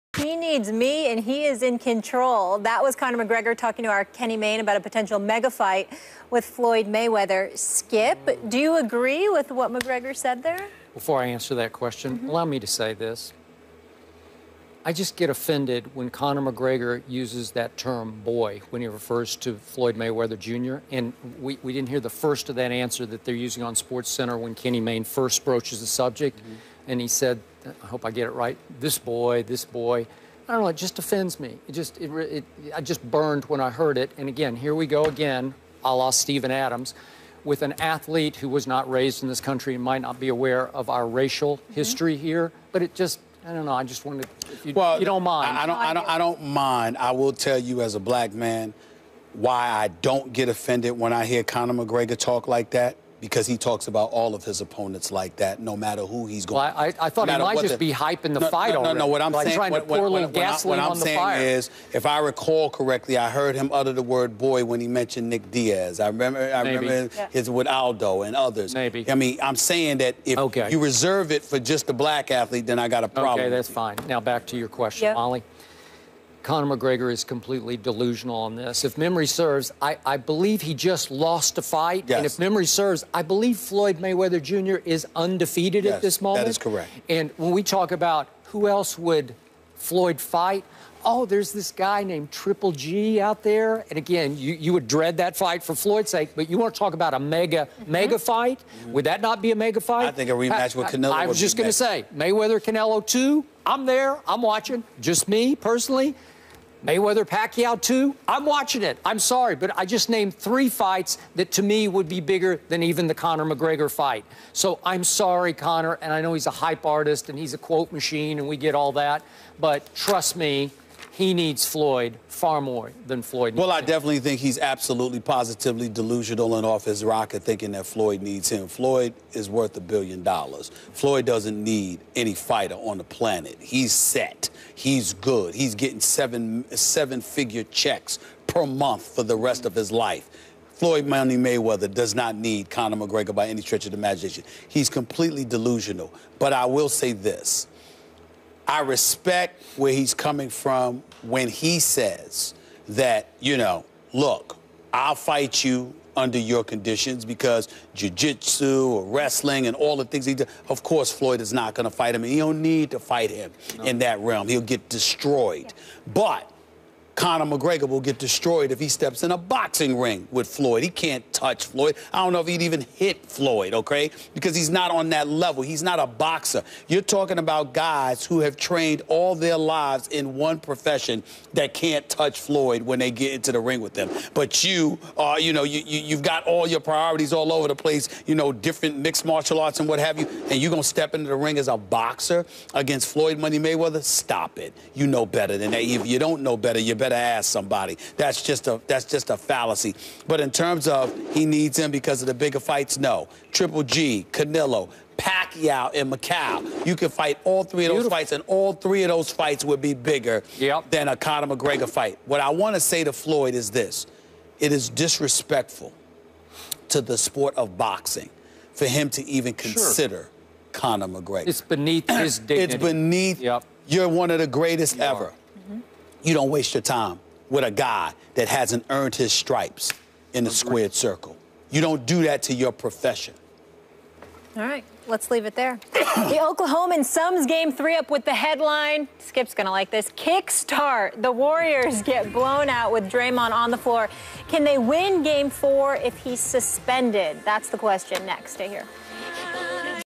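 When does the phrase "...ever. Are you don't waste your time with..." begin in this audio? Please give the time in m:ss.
3:45.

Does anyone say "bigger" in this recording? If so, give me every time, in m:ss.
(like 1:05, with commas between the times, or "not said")
1:52, 3:22, 3:29.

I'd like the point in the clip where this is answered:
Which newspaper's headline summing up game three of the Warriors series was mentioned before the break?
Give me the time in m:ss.
3:55.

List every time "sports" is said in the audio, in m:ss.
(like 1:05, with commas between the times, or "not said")
0:23, 3:37.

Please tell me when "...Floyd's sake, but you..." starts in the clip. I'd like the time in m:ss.
1:35.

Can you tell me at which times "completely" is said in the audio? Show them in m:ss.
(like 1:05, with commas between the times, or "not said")
1:17, 2:24.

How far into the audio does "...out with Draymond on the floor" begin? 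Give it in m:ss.
4:02.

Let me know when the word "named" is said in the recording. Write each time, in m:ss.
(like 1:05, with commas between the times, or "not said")
1:32, 1:50.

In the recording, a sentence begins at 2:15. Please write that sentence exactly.
He's getting seven seven figure checks per month for the rest of his life.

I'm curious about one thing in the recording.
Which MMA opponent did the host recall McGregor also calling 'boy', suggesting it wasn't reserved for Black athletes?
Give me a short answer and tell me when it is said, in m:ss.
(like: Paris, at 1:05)
Nick Diaz, at 1:05.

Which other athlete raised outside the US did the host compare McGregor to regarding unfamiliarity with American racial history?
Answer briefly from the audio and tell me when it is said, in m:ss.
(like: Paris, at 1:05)
Steven Adams, at 0:36.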